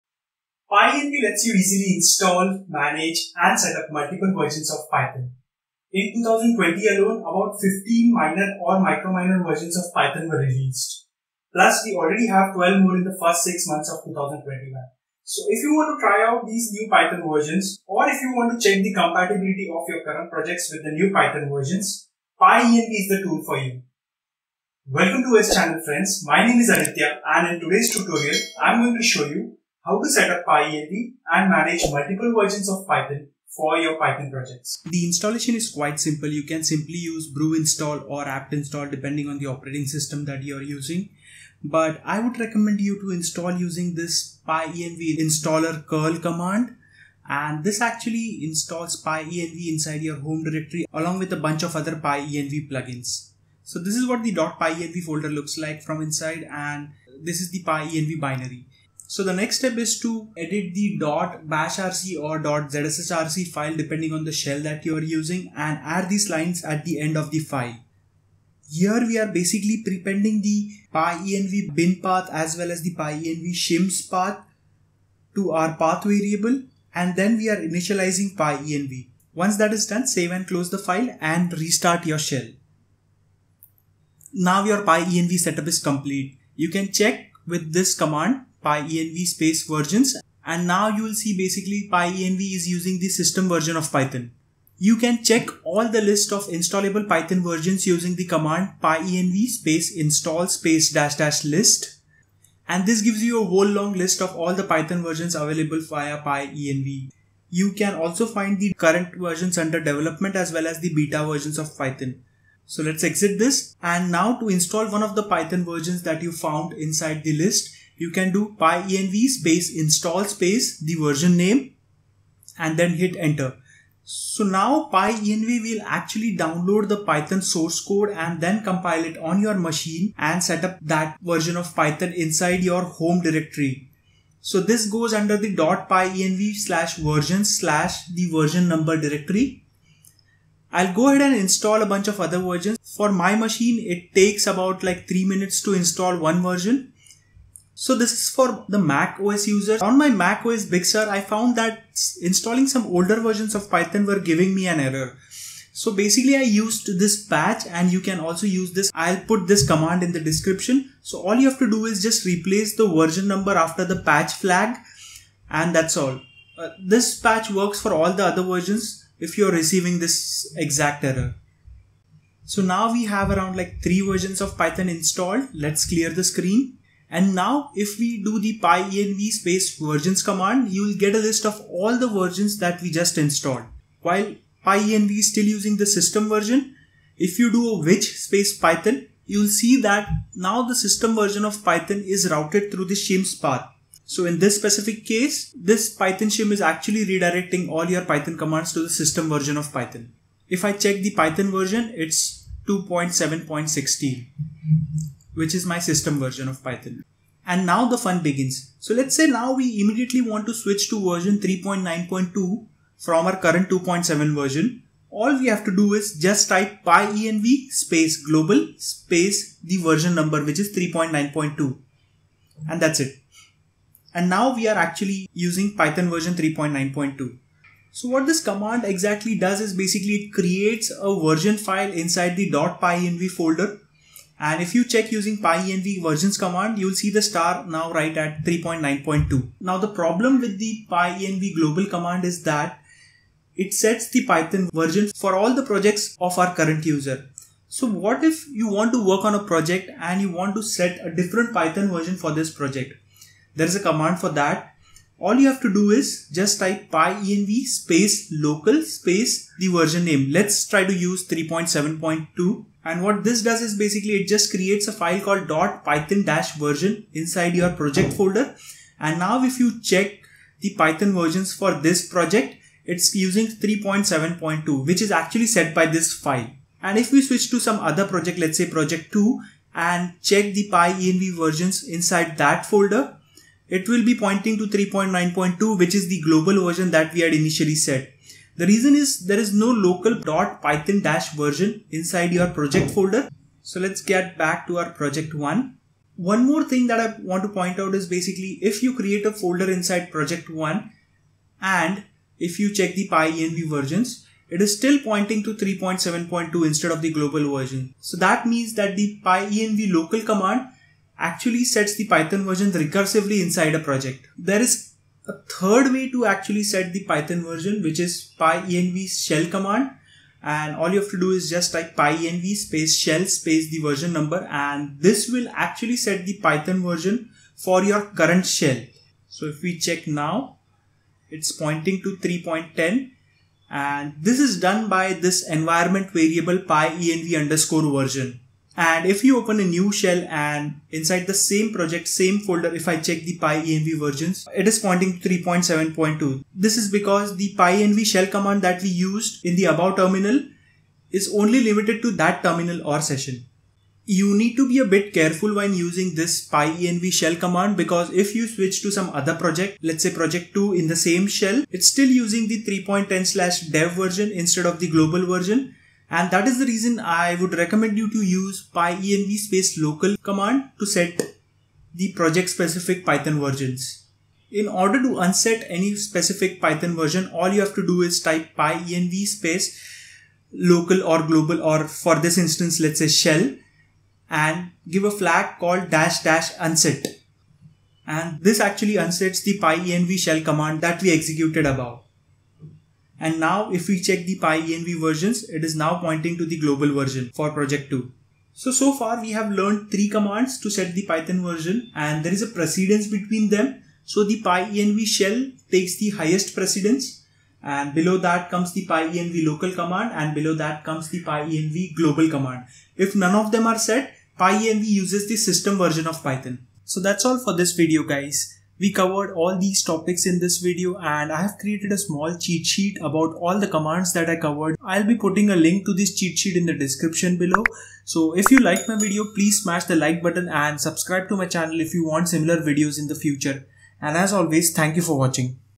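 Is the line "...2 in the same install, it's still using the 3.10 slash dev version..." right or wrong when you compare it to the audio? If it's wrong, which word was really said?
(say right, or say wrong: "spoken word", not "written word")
wrong: "shell", not "install".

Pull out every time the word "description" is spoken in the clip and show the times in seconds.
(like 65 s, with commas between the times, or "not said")
160 s, 426 s.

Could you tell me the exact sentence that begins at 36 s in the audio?
You can simply use brew install or apt install depending on the operating system that you're using.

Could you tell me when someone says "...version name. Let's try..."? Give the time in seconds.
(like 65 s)
259 s.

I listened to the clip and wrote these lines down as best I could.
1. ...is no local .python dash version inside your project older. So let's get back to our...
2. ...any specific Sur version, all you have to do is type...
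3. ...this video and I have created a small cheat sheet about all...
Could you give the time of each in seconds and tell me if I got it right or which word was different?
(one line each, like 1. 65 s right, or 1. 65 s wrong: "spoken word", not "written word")
1. 289 s wrong: "folder", not "older"
2. 375 s wrong: "Python", not "Sur"
3. 420 s right.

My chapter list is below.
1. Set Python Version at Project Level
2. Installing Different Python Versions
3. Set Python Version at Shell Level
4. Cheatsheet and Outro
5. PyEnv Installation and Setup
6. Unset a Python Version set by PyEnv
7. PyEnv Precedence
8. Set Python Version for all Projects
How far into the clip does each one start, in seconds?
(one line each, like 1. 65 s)
1. 239 s
2. 94 s
3. 314 s
4. 416 s
5. 34 s
6. 374 s
7. 398 s
8. 207 s.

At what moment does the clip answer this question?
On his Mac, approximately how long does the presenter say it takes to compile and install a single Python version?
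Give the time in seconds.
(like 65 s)
145 s.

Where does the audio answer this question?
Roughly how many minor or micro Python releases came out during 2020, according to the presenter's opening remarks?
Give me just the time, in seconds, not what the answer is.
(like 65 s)
7 s.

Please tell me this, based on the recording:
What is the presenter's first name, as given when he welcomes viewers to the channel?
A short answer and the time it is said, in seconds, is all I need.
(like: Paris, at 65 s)
Aditya, at 26 s.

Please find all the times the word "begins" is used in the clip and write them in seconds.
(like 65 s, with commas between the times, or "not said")
208 s.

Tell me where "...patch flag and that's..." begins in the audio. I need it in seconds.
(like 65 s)
164 s.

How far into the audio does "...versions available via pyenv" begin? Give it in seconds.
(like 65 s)
105 s.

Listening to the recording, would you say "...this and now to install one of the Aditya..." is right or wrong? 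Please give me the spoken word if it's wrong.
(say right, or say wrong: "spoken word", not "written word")
wrong: "Python", not "Aditya".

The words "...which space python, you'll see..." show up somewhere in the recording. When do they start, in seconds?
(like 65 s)
187 s.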